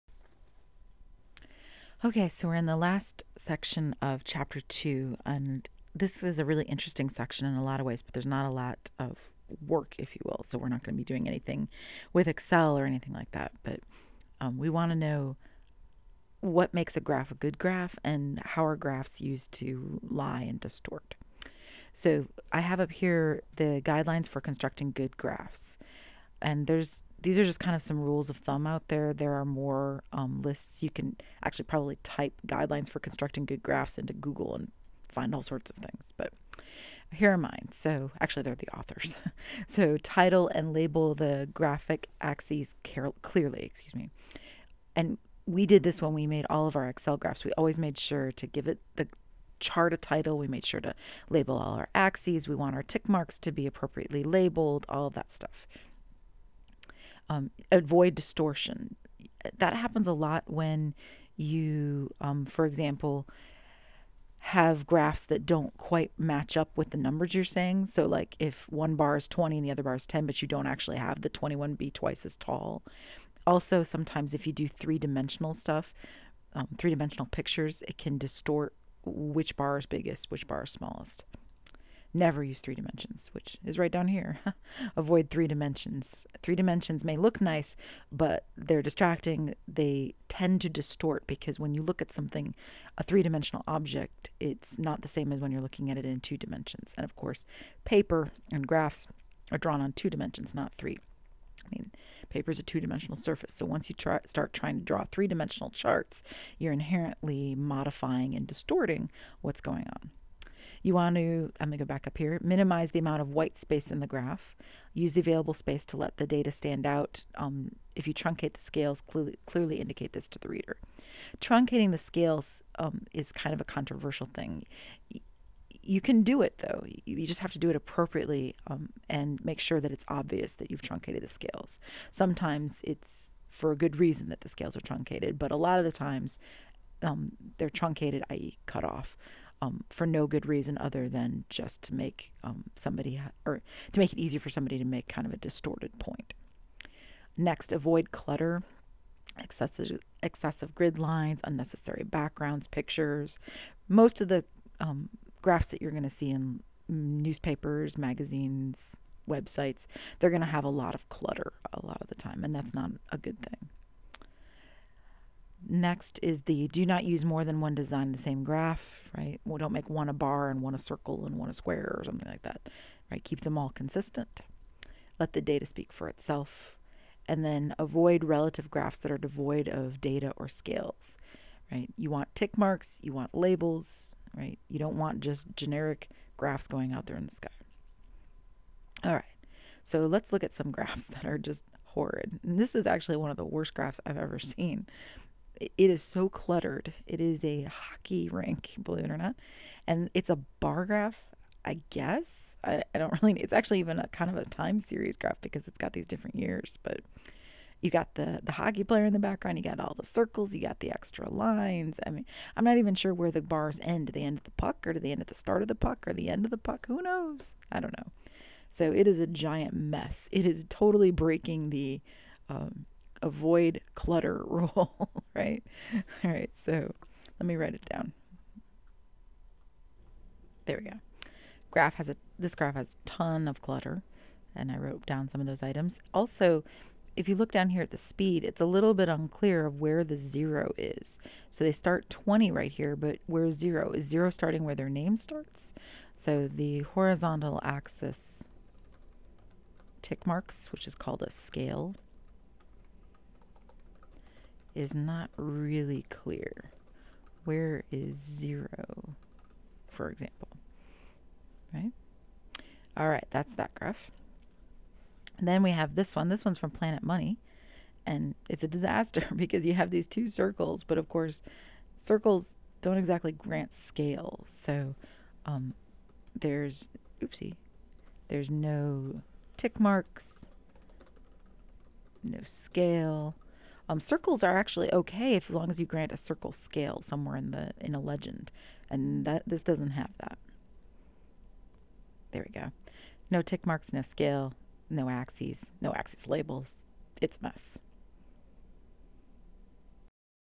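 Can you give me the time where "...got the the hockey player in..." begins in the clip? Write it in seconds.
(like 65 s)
207 s.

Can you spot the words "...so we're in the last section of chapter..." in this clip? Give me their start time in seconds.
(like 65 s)
2 s.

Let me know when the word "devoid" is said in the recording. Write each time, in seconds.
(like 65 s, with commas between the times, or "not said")
179 s.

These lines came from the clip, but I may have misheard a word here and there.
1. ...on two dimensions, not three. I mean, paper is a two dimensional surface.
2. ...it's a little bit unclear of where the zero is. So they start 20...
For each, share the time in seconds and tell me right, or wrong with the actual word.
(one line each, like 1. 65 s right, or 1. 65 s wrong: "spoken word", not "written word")
1. 99 s right
2. 238 s right.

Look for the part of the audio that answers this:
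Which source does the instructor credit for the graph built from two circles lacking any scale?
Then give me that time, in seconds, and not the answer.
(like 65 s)
266 s.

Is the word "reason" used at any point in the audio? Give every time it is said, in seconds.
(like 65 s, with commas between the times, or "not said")
133 s, 140 s.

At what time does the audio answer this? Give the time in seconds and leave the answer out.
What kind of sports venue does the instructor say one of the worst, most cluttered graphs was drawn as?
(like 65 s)
197 s.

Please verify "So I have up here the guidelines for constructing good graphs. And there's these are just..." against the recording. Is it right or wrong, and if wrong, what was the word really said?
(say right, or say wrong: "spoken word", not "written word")
right.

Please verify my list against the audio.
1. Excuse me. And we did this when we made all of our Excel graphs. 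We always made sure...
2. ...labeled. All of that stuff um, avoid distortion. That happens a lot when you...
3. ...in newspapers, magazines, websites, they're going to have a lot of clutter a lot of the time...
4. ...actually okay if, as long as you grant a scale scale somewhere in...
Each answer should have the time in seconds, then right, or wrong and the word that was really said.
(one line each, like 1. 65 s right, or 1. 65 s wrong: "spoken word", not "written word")
1. 43 s right
2. 54 s right
3. 156 s right
4. 284 s wrong: "circle", not "scale".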